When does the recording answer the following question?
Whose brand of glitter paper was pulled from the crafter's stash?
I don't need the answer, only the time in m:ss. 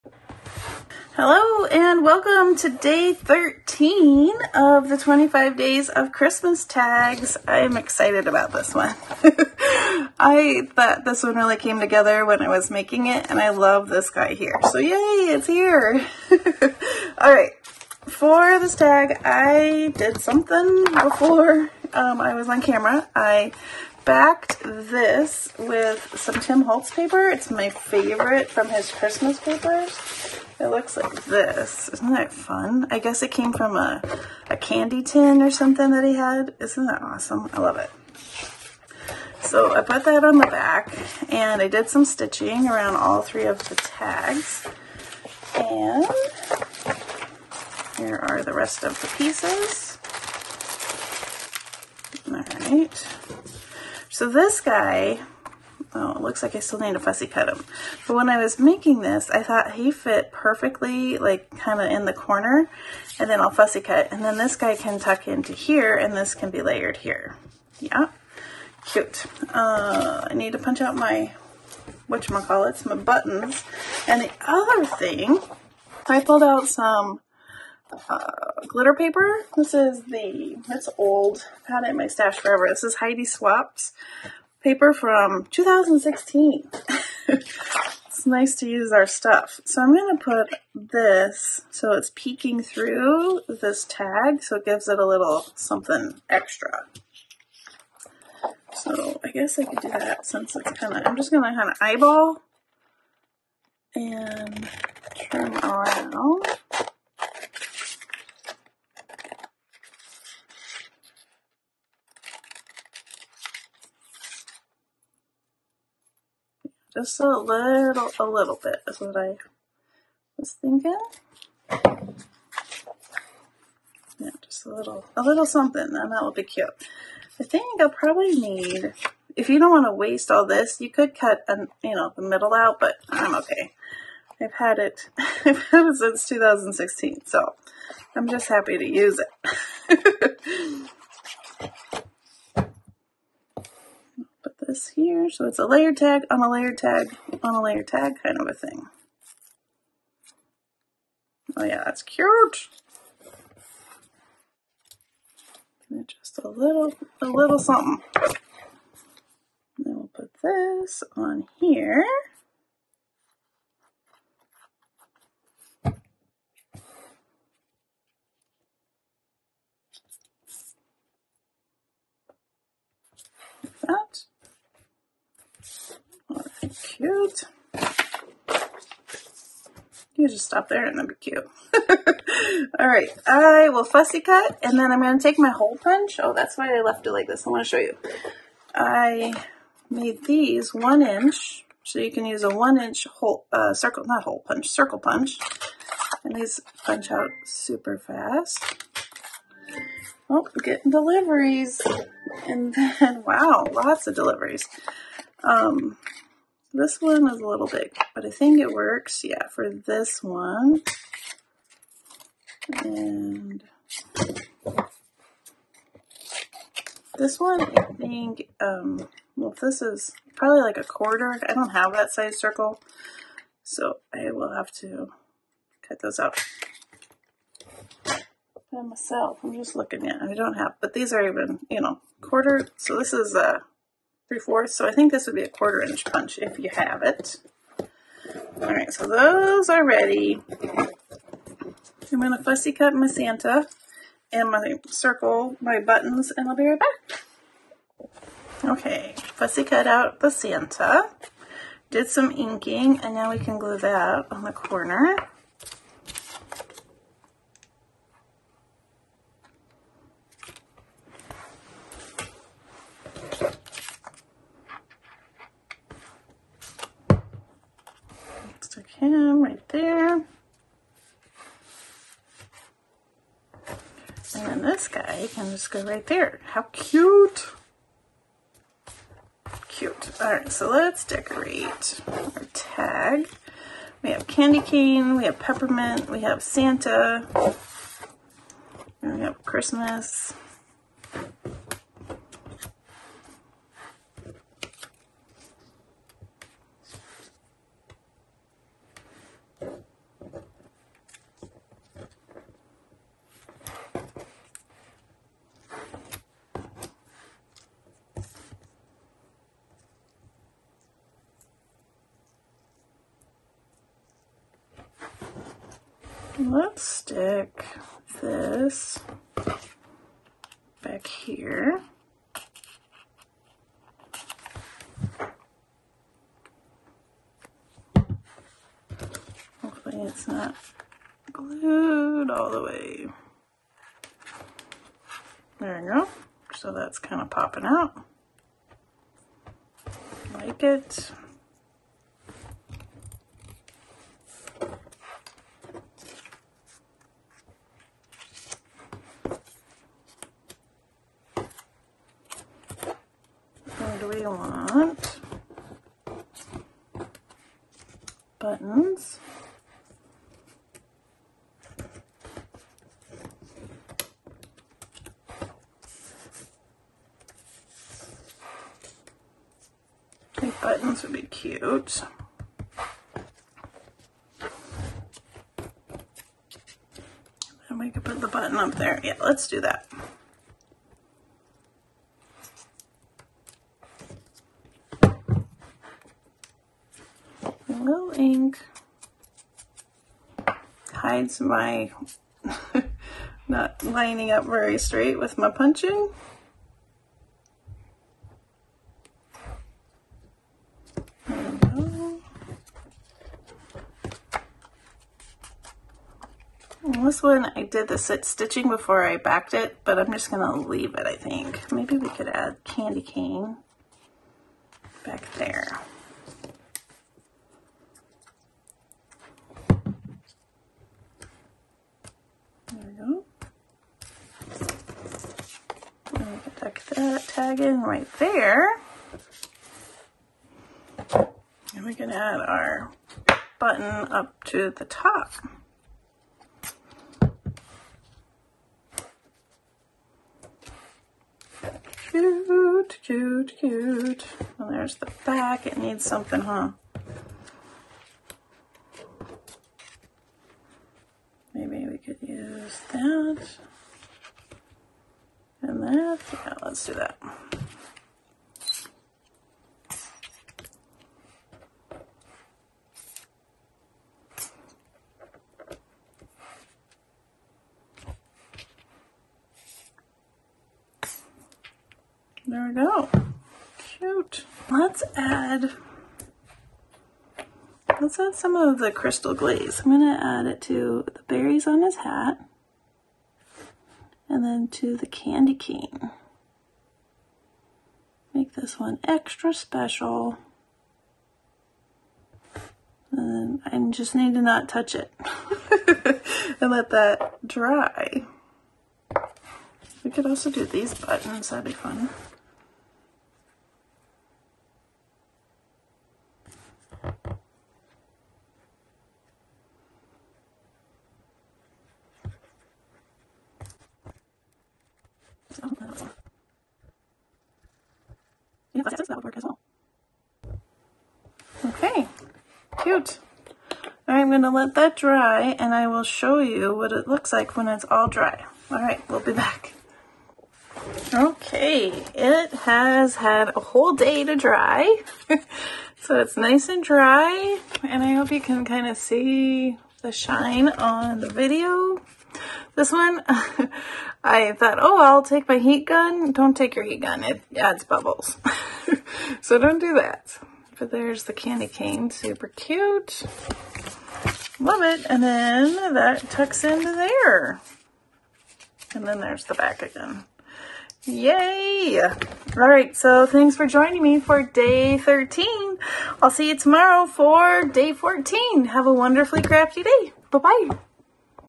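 1:22.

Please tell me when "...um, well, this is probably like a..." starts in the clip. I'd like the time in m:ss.
3:38.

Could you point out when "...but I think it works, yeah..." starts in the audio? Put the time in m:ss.
3:28.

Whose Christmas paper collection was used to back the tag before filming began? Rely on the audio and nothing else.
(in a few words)
Tim Holtz.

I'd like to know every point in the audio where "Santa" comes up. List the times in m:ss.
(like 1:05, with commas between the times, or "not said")
4:03, 4:10, 4:46.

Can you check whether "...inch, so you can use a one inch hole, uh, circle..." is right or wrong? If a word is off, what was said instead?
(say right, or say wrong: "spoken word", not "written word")
right.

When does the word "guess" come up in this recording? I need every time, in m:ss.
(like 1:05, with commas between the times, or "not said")
0:32, 1:39.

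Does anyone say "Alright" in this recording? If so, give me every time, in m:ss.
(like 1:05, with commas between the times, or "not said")
4:40.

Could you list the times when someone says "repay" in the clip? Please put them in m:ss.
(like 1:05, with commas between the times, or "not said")
not said.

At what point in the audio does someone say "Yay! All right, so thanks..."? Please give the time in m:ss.
9:21.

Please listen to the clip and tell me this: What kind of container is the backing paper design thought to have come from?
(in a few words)
A candy tin.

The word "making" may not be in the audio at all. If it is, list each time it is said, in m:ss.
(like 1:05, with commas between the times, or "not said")
0:12, 0:58.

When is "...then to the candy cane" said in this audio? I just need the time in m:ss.
8:04.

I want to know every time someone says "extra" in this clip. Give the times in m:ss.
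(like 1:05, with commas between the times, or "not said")
1:36, 8:09.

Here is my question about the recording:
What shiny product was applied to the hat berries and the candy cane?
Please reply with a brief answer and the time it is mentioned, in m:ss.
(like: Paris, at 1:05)
Crystal glaze, at 7:58.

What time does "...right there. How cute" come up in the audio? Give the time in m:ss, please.
4:35.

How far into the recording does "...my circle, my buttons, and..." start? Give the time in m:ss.
4:04.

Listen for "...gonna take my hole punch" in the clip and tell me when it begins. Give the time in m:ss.
3:05.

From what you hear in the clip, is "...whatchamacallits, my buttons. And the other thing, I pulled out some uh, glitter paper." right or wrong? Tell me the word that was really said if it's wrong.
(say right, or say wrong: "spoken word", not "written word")
right.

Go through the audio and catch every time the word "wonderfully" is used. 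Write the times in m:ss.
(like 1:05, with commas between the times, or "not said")
9:28.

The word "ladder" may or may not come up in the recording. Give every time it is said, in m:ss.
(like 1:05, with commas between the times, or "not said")
not said.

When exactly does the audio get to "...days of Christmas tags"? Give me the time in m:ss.
0:05.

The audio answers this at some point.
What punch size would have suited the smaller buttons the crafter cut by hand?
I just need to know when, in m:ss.
3:55.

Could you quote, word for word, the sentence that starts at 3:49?
I'm just looking at, I don't have, but these are even, you know, quarter.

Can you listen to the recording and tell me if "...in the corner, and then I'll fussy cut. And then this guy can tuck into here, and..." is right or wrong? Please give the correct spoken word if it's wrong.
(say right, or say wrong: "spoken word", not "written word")
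right.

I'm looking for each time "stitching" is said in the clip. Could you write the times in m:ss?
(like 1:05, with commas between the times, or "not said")
0:42, 6:48.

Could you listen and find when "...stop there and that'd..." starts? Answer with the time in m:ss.
3:00.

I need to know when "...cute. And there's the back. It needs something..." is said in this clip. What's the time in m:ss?
7:23.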